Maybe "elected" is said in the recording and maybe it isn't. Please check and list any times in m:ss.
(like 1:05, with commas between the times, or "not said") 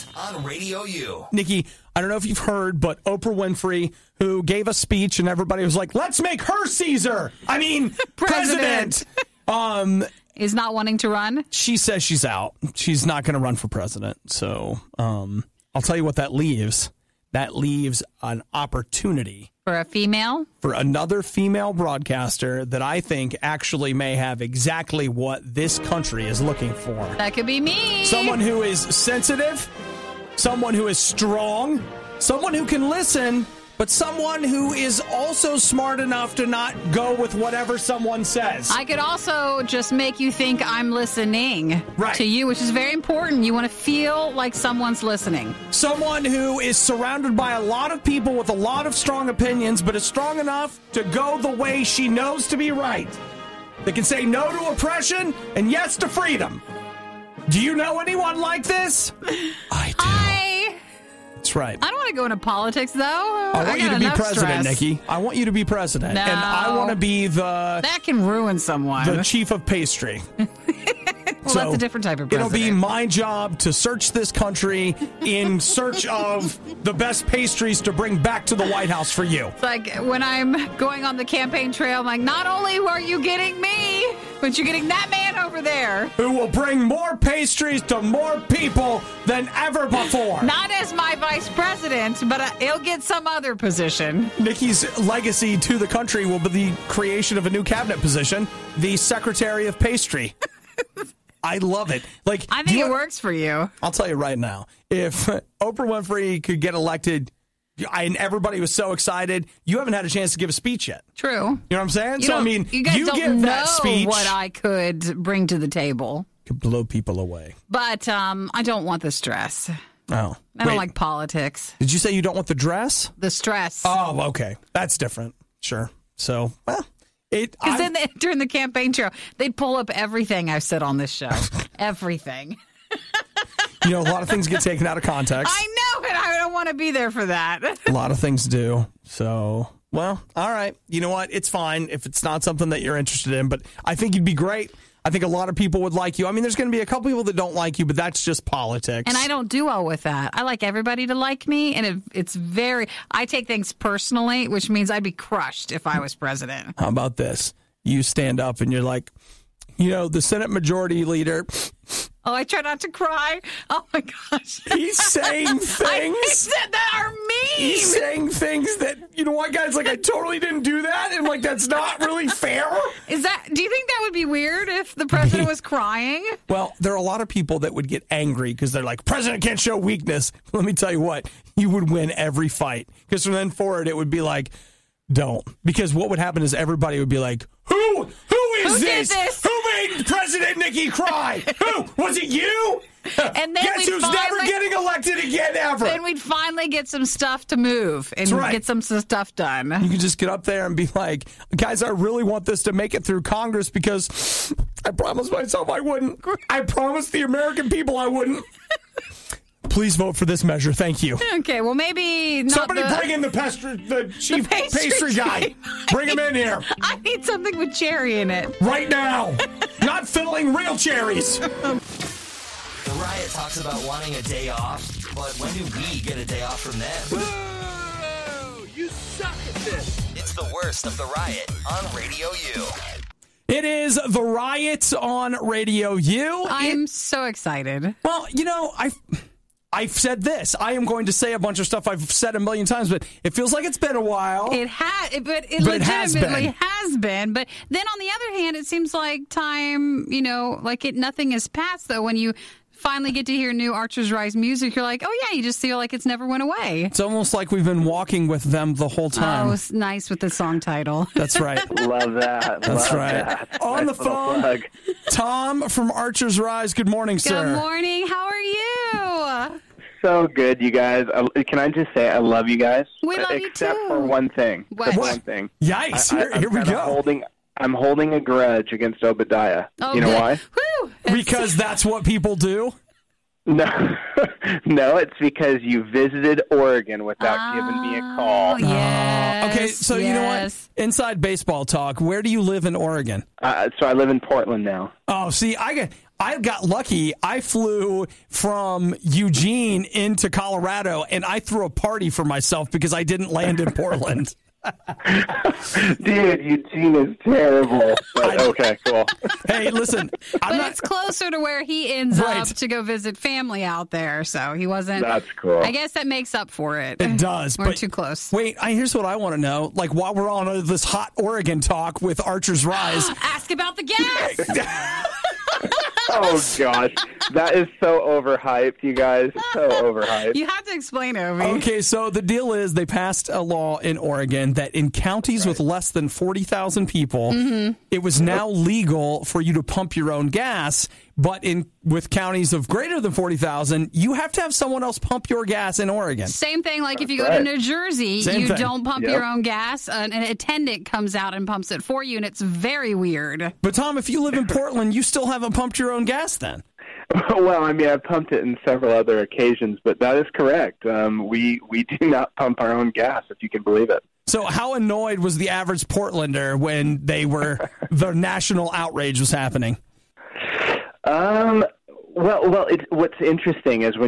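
1:46, 3:14.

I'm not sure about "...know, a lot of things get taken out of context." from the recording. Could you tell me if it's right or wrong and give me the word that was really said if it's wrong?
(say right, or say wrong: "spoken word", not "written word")
right.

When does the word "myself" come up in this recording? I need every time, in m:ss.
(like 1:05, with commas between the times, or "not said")
3:25, 5:02.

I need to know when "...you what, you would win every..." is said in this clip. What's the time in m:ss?
3:00.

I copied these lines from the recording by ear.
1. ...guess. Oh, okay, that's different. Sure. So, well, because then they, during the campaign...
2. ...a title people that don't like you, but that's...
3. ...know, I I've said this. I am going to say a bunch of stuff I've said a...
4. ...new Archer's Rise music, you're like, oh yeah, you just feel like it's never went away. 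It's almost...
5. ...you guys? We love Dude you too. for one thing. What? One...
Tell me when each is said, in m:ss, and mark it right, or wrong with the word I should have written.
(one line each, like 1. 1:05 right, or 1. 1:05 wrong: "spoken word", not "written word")
1. 2:03 wrong: "stress", not "guess"
2. 2:26 wrong: "couple", not "title"
3. 3:58 right
4. 4:13 right
5. 4:32 wrong: "Except", not "Dude".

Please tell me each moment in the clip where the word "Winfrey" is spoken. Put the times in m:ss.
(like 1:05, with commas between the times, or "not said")
0:03, 1:45.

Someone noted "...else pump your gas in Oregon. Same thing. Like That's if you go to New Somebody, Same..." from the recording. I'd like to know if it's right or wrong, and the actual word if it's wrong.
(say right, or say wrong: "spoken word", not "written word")
wrong: "Jersey", not "Somebody".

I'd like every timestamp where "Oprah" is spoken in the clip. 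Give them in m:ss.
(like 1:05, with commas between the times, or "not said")
0:03, 1:45.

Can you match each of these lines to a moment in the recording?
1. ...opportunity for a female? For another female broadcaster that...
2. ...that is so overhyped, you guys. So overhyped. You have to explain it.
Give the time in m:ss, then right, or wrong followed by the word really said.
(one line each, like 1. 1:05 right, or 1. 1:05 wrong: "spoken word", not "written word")
1. 0:18 right
2. 5:27 right.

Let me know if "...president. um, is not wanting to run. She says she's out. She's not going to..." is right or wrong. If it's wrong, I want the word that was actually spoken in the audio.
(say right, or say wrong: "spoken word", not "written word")
right.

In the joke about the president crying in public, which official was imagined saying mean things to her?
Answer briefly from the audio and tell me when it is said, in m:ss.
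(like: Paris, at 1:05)
Senate Majority Leader, at 2:40.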